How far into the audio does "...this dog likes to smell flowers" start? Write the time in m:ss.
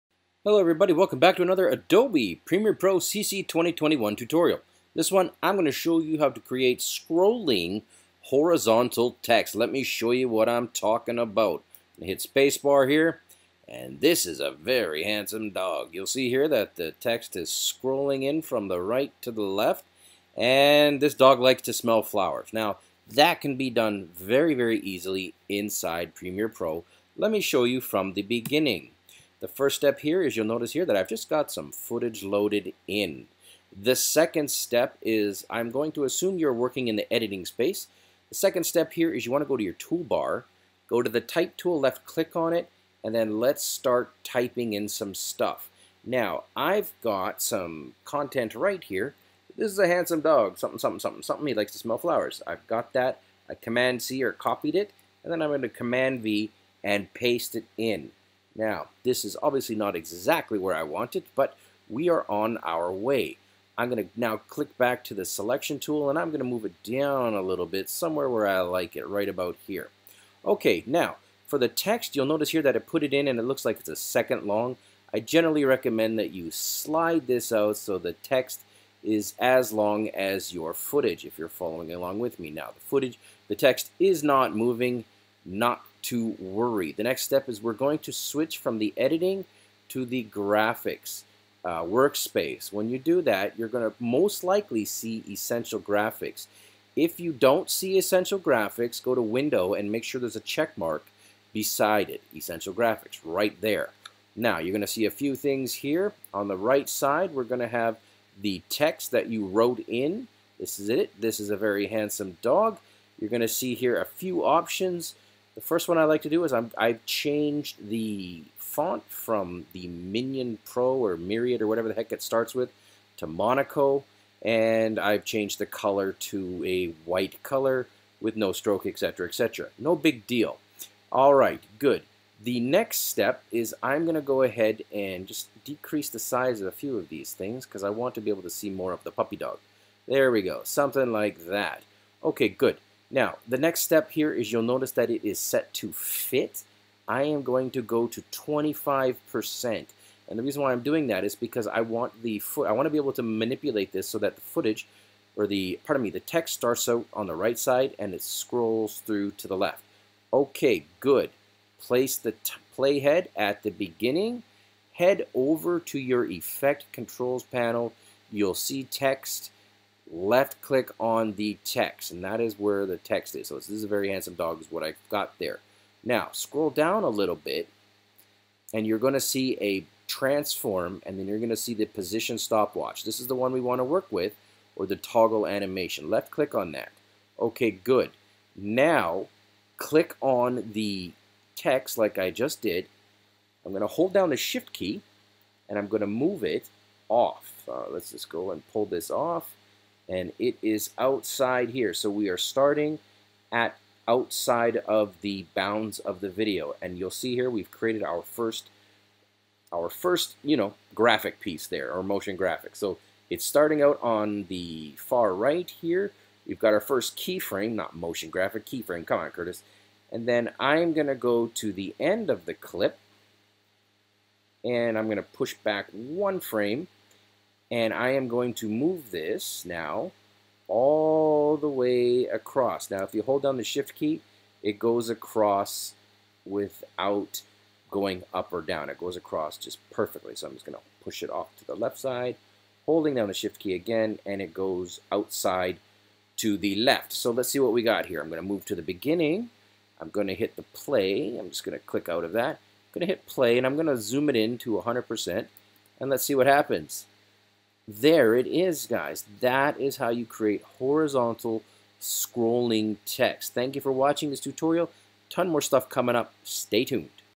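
0:21.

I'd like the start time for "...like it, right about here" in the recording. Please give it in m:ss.
1:08.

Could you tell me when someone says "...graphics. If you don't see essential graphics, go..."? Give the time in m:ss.
1:35.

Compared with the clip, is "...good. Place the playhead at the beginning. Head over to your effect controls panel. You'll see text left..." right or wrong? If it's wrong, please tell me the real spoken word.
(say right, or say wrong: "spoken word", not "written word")
right.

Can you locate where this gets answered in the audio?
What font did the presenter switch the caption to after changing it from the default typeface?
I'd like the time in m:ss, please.
2:03.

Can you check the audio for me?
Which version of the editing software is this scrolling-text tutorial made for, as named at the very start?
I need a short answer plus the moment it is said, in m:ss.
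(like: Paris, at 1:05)
Premiere Pro CC 2021, at 0:02.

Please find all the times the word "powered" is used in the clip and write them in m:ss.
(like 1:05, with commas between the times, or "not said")
not said.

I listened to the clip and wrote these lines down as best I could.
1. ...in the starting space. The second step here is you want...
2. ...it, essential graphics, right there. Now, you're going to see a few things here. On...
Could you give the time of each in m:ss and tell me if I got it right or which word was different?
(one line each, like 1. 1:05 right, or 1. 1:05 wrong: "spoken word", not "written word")
1. 0:36 wrong: "editing", not "starting"
2. 1:42 right.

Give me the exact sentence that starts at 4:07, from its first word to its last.
So let's see what we got here.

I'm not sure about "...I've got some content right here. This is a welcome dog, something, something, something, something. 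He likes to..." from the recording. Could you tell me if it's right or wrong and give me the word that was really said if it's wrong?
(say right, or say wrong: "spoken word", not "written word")
wrong: "handsome", not "welcome".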